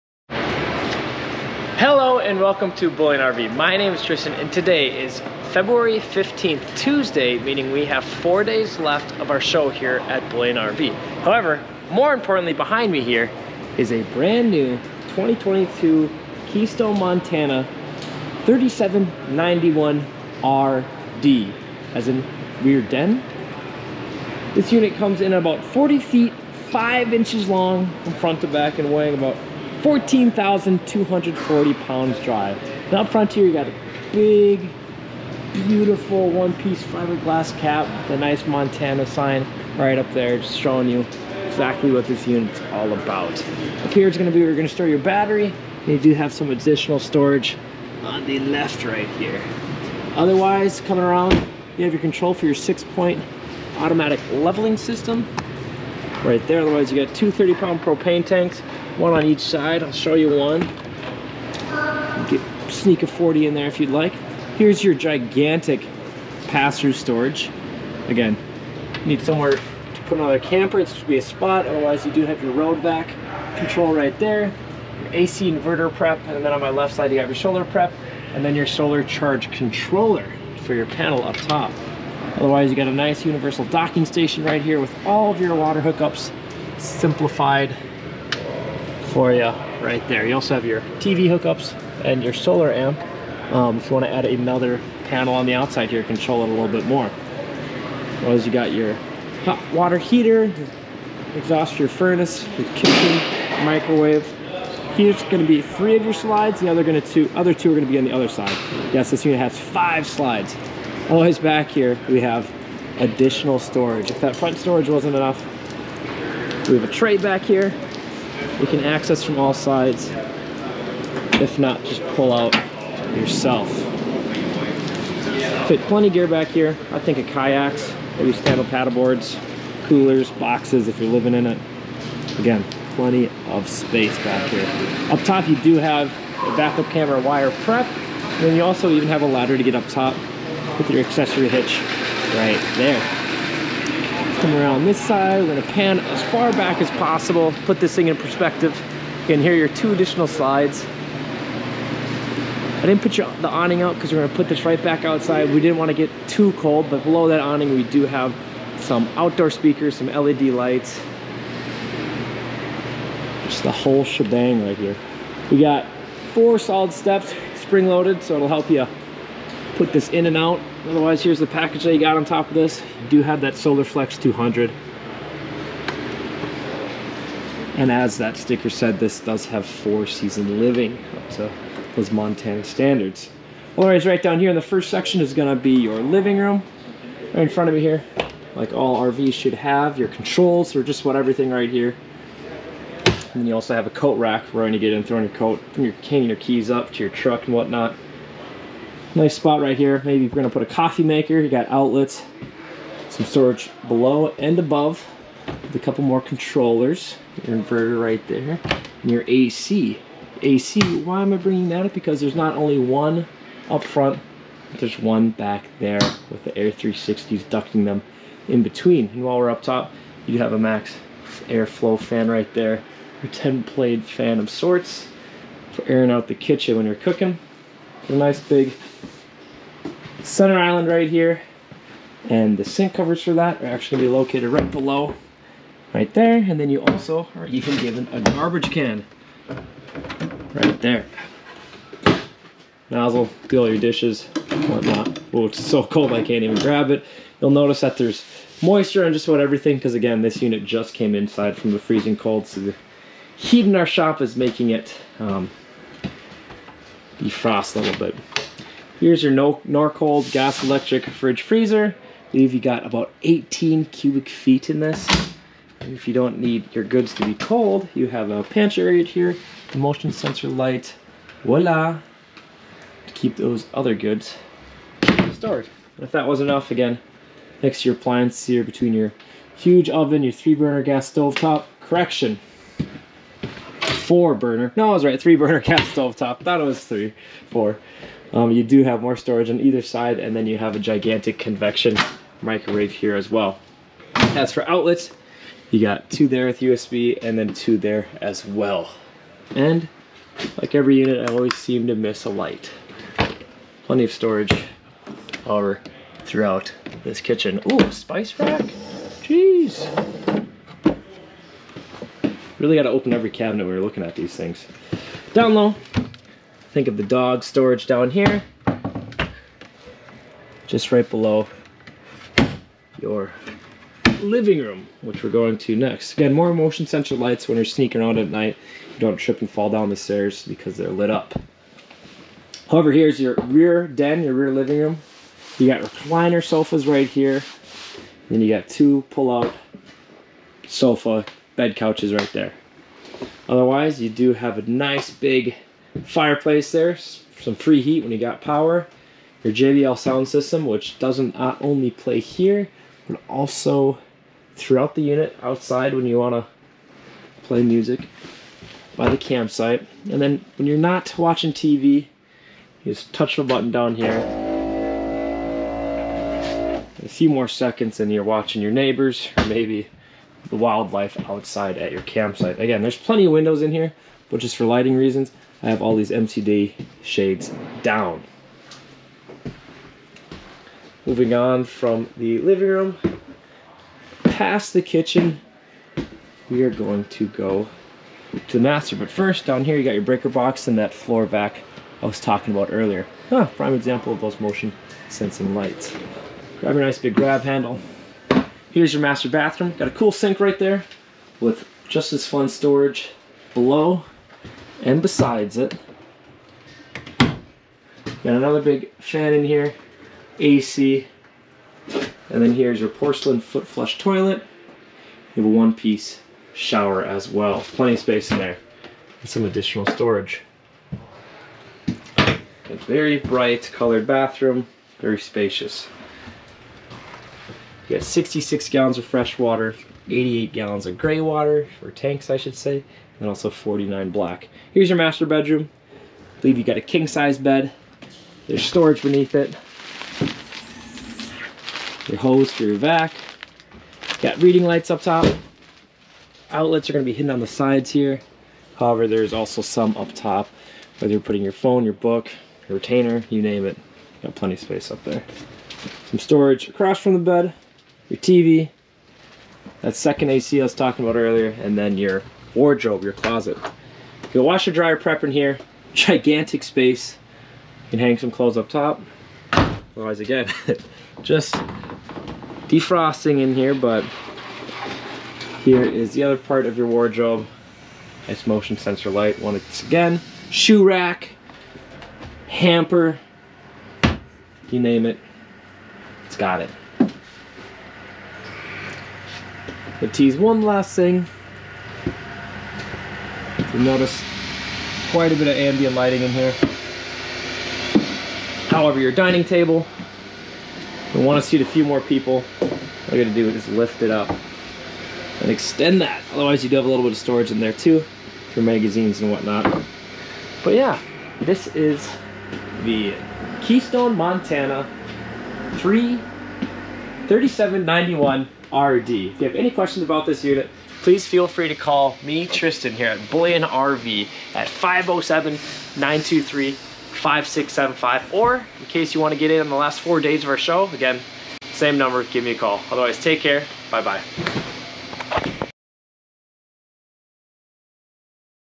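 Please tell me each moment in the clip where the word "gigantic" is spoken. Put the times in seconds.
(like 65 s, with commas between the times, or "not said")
64 s, 290 s, 465 s.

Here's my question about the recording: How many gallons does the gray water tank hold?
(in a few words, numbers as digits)
88 gallons.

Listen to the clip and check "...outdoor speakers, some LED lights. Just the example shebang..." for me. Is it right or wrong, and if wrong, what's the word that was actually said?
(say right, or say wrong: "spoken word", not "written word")
wrong: "whole", not "example".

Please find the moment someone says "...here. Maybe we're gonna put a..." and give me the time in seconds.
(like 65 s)
199 s.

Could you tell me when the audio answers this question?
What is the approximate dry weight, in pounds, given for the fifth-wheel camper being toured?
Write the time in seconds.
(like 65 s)
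29 s.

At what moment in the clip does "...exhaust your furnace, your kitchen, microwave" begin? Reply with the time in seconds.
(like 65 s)
101 s.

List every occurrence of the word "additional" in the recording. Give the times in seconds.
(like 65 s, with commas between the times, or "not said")
46 s, 112 s, 149 s, 419 s.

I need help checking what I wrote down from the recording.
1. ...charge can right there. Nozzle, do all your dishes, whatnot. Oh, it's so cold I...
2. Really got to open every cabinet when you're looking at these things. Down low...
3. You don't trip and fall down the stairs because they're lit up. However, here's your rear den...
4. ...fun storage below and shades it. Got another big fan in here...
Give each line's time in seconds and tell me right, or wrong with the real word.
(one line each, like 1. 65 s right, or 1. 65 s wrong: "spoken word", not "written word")
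1. 238 s wrong: "garbage", not "charge"
2. 312 s right
3. 328 s right
4. 402 s wrong: "besides", not "shades".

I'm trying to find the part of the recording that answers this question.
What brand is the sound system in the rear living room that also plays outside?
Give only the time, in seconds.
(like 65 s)
349 s.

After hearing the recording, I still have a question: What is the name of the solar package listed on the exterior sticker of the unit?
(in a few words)
Solar Flex 200.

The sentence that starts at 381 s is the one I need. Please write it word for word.
Moving on from the living room, past the kitchen, we are going to go to the master.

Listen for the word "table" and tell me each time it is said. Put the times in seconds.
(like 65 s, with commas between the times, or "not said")
499 s.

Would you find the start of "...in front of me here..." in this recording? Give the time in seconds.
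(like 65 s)
187 s.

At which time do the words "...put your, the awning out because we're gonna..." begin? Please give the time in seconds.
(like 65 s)
153 s.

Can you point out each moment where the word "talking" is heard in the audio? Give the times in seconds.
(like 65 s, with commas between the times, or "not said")
392 s, 460 s.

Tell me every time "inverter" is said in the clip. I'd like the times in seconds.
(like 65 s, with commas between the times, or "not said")
75 s, 207 s.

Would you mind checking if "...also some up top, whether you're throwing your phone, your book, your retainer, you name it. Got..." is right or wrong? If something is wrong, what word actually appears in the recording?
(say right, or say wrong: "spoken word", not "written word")
wrong: "putting", not "throwing".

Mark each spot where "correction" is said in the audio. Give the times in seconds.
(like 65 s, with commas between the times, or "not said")
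281 s.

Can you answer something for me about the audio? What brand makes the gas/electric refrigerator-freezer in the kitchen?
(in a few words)
Norcold.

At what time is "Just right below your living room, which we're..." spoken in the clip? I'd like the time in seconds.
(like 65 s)
320 s.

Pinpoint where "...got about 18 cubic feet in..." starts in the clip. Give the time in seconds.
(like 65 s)
262 s.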